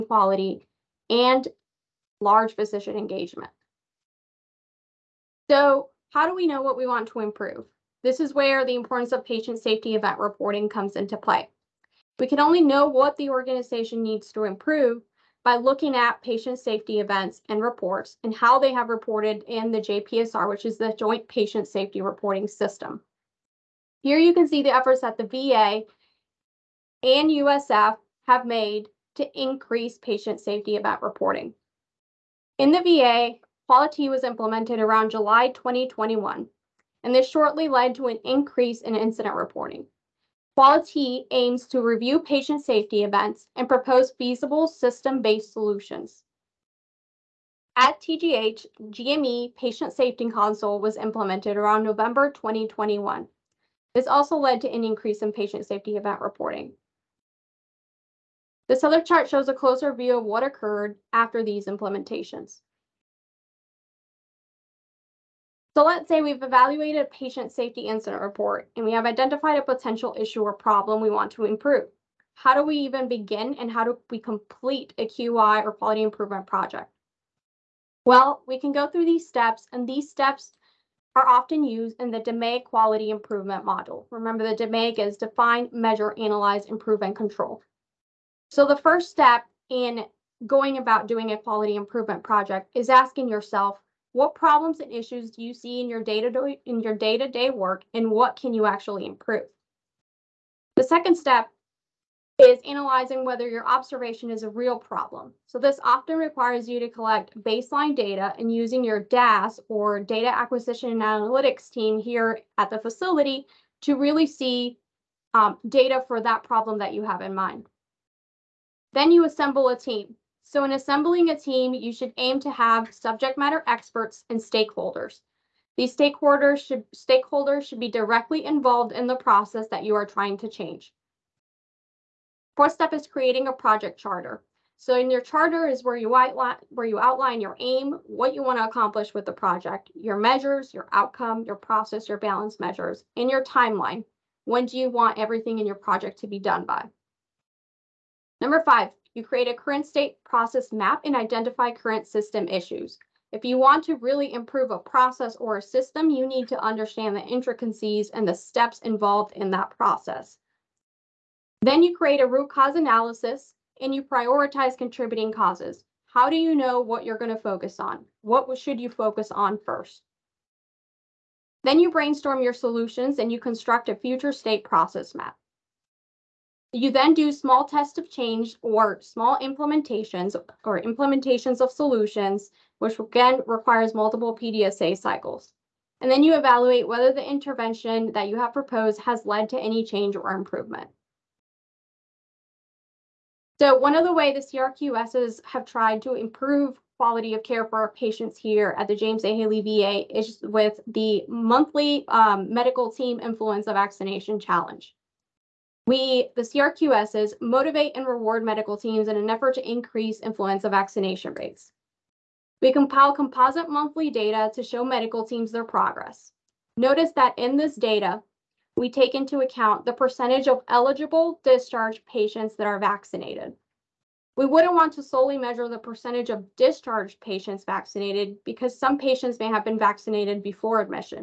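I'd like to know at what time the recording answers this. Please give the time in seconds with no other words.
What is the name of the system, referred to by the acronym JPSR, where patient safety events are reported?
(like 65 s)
20 s.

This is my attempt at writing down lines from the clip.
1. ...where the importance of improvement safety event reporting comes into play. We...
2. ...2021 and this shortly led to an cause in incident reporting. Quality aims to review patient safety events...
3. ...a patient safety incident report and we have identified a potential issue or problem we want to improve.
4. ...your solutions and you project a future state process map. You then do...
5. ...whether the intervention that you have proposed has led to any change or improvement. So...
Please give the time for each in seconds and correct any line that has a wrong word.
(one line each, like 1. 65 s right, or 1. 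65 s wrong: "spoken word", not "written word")
1. 8 s wrong: "patient", not "improvement"
2. 35 s wrong: "increase", not "cause"
3. 67 s right
4. 172 s wrong: "construct", not "project"
5. 186 s right.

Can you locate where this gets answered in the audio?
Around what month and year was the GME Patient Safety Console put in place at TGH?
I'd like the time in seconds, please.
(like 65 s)
51 s.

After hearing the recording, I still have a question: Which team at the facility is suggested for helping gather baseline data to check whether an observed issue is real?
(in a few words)
data acquisition and analytics.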